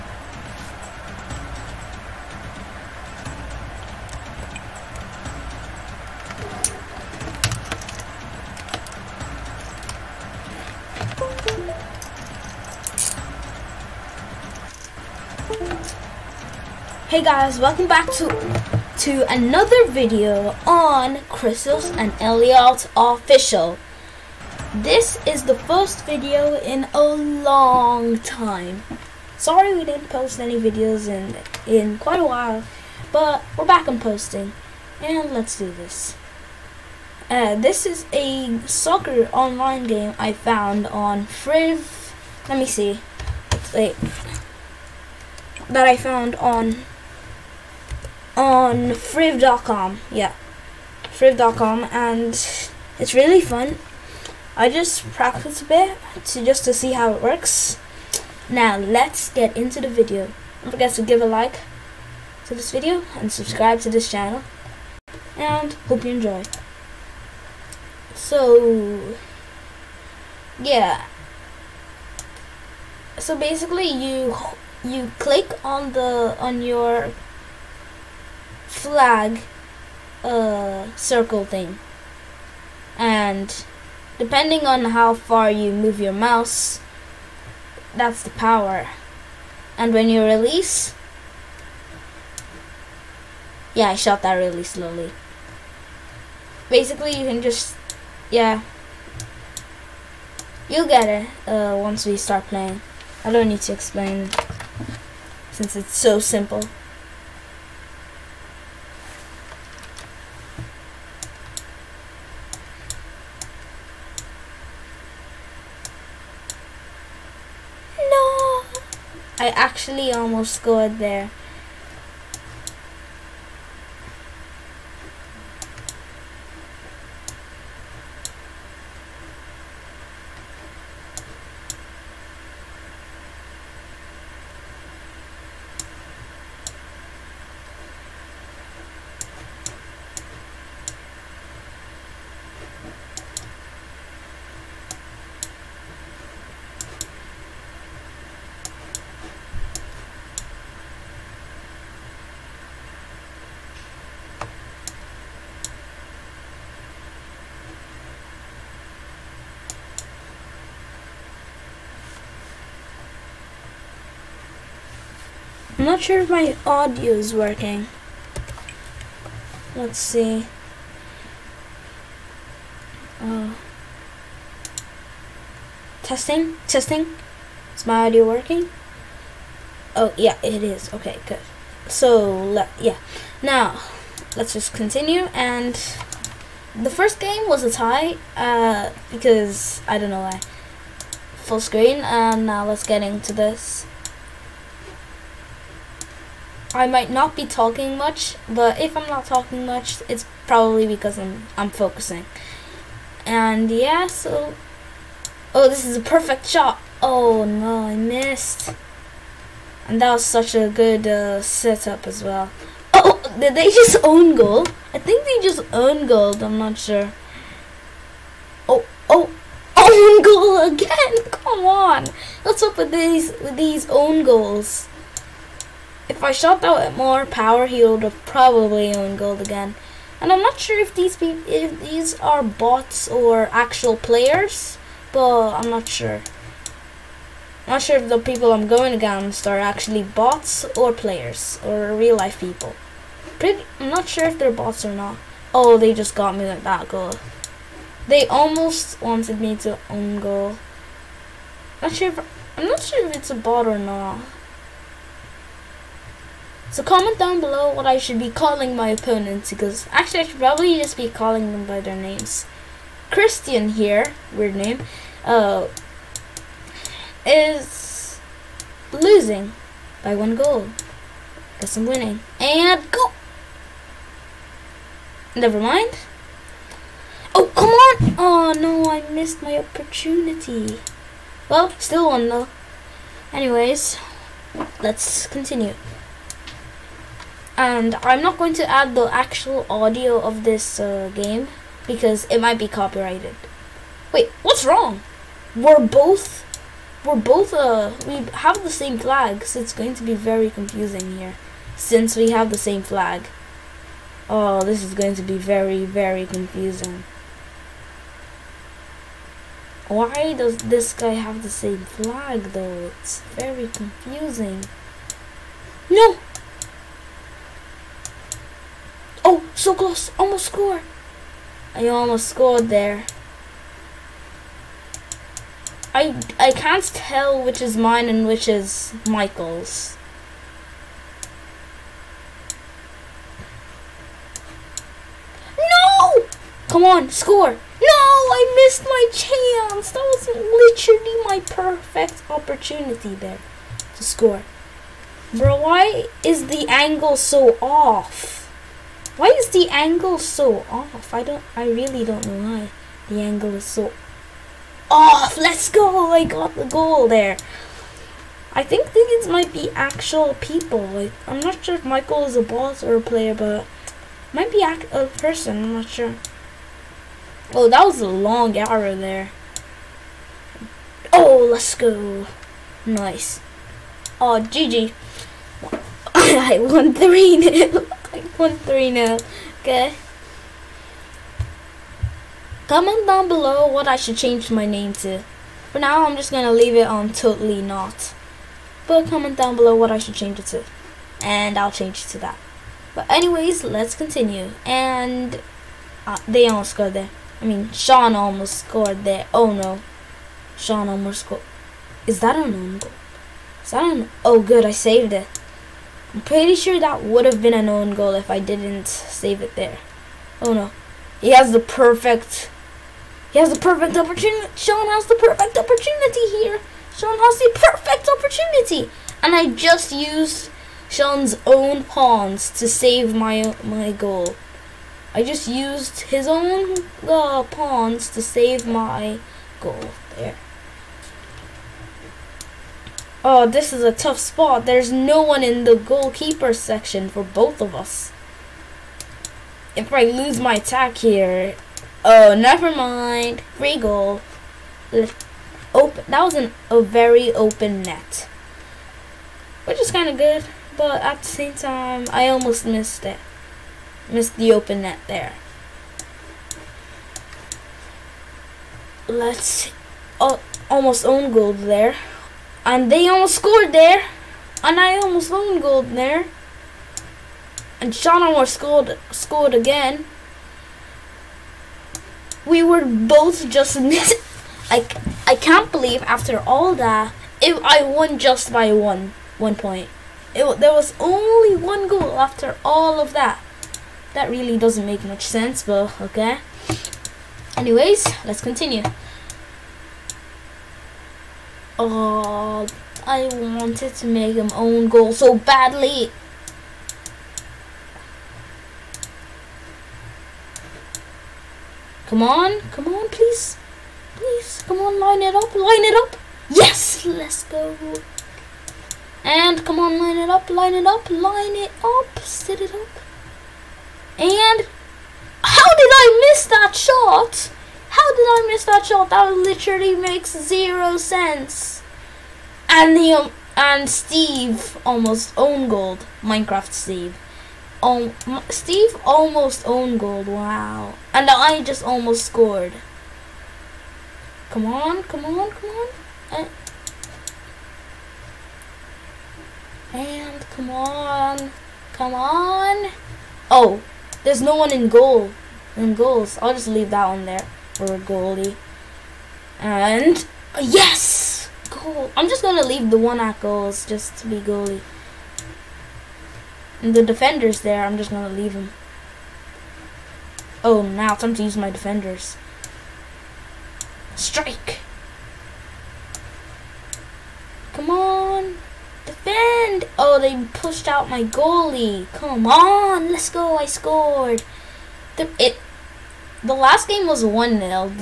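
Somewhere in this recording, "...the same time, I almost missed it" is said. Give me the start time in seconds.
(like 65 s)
451 s.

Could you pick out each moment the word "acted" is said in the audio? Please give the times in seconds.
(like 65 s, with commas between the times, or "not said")
not said.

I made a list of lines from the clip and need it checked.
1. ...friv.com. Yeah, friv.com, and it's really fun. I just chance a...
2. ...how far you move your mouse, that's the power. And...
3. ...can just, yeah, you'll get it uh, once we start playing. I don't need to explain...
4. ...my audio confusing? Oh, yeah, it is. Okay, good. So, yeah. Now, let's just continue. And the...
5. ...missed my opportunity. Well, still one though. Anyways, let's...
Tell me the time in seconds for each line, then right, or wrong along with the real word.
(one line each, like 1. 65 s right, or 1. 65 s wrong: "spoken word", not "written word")
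1. 48 s wrong: "practice", not "chance"
2. 84 s right
3. 97 s right
4. 177 s wrong: "working", not "confusing"
5. 279 s right.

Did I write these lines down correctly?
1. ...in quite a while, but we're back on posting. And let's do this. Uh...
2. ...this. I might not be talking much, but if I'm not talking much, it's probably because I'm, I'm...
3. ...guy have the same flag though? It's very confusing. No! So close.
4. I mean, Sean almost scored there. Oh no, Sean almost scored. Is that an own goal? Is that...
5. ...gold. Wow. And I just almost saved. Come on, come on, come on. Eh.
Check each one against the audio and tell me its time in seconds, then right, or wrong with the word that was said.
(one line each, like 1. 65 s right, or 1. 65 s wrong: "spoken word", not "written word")
1. 31 s right
2. 193 s right
3. 310 s right
4. 397 s right
5. 529 s wrong: "scored", not "saved".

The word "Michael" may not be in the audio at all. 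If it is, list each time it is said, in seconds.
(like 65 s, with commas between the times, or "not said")
329 s, 361 s.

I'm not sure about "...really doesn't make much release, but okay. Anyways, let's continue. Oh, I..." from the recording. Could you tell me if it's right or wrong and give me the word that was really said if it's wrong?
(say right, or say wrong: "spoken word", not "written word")
wrong: "sense", not "release".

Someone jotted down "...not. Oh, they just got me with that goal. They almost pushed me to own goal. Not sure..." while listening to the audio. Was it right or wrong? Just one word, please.
wrong.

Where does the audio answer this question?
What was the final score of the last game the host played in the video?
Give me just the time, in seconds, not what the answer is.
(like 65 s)
577 s.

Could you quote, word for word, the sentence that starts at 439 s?
If I lose my attack here...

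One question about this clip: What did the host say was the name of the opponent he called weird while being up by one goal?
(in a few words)
Christian.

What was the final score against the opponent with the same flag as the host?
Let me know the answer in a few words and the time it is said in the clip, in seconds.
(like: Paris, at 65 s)
3-0, at 376 s.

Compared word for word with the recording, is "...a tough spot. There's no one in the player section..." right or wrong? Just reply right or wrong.
wrong.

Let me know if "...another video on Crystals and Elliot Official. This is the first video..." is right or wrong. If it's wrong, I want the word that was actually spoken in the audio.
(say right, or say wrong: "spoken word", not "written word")
right.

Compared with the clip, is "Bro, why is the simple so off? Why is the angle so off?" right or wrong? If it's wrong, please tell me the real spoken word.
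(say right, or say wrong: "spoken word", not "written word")
wrong: "angle", not "simple".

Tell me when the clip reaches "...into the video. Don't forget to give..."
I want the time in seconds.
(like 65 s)
59 s.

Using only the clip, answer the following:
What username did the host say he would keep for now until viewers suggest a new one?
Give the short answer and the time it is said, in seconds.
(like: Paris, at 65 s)
totally not, at 387 s.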